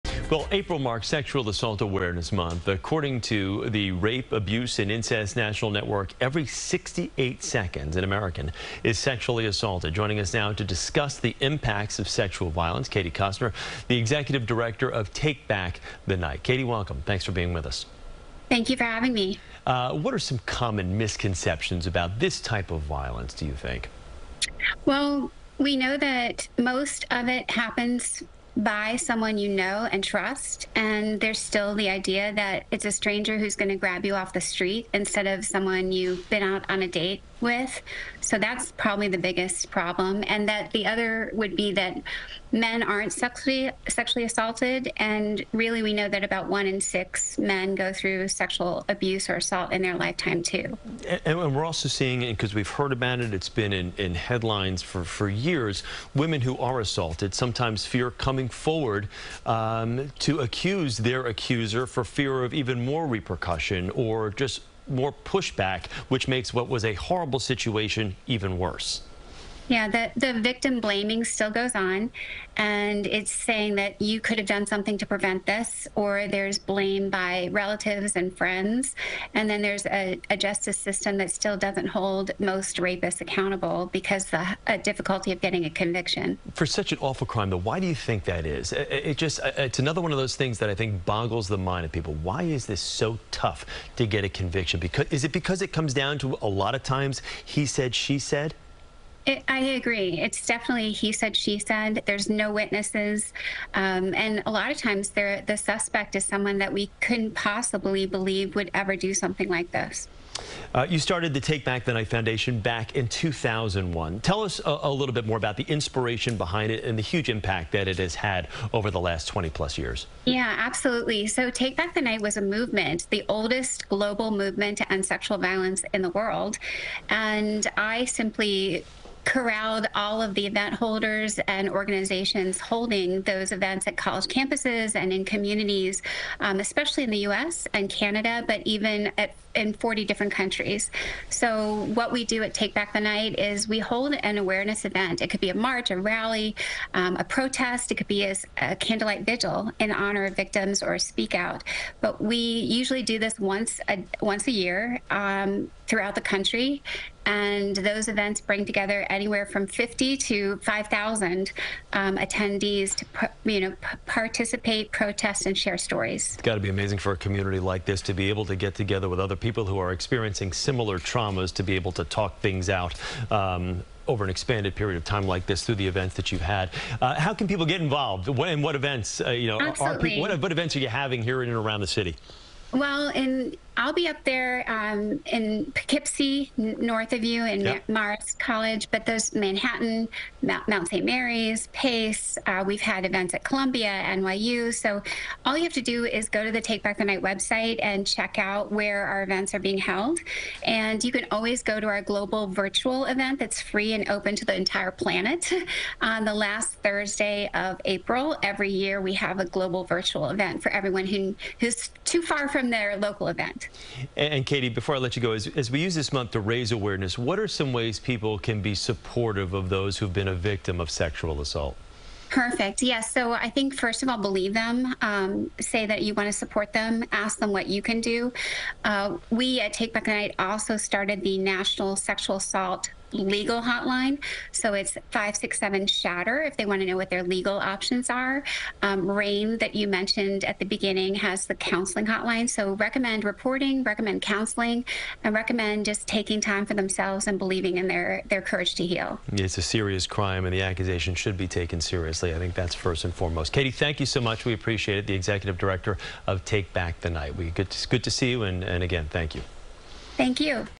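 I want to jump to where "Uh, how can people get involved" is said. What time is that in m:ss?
2:57.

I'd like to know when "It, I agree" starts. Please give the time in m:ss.
1:39.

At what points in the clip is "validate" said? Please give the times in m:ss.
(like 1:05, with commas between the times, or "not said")
not said.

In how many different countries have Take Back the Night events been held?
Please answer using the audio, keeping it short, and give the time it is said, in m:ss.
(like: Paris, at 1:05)
40, at 2:19.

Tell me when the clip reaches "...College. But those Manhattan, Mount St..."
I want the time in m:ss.
3:08.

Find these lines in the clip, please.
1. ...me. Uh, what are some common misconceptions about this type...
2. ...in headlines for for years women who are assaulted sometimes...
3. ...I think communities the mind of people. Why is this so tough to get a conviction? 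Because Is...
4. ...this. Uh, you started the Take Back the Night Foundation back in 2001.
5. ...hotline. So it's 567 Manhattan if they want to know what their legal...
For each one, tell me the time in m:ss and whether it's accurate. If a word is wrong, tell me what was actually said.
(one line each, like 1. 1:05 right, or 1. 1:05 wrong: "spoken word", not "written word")
1. 0:19 right
2. 0:53 right
3. 1:30 wrong: "boggles", not "communities"
4. 1:49 right
5. 3:53 wrong: "Shatter", not "Manhattan".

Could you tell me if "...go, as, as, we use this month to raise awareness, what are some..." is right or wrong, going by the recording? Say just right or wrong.
right.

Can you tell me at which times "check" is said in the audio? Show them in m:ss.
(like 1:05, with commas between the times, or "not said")
3:18.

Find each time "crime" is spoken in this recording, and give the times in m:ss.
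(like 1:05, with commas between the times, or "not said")
1:27, 4:10.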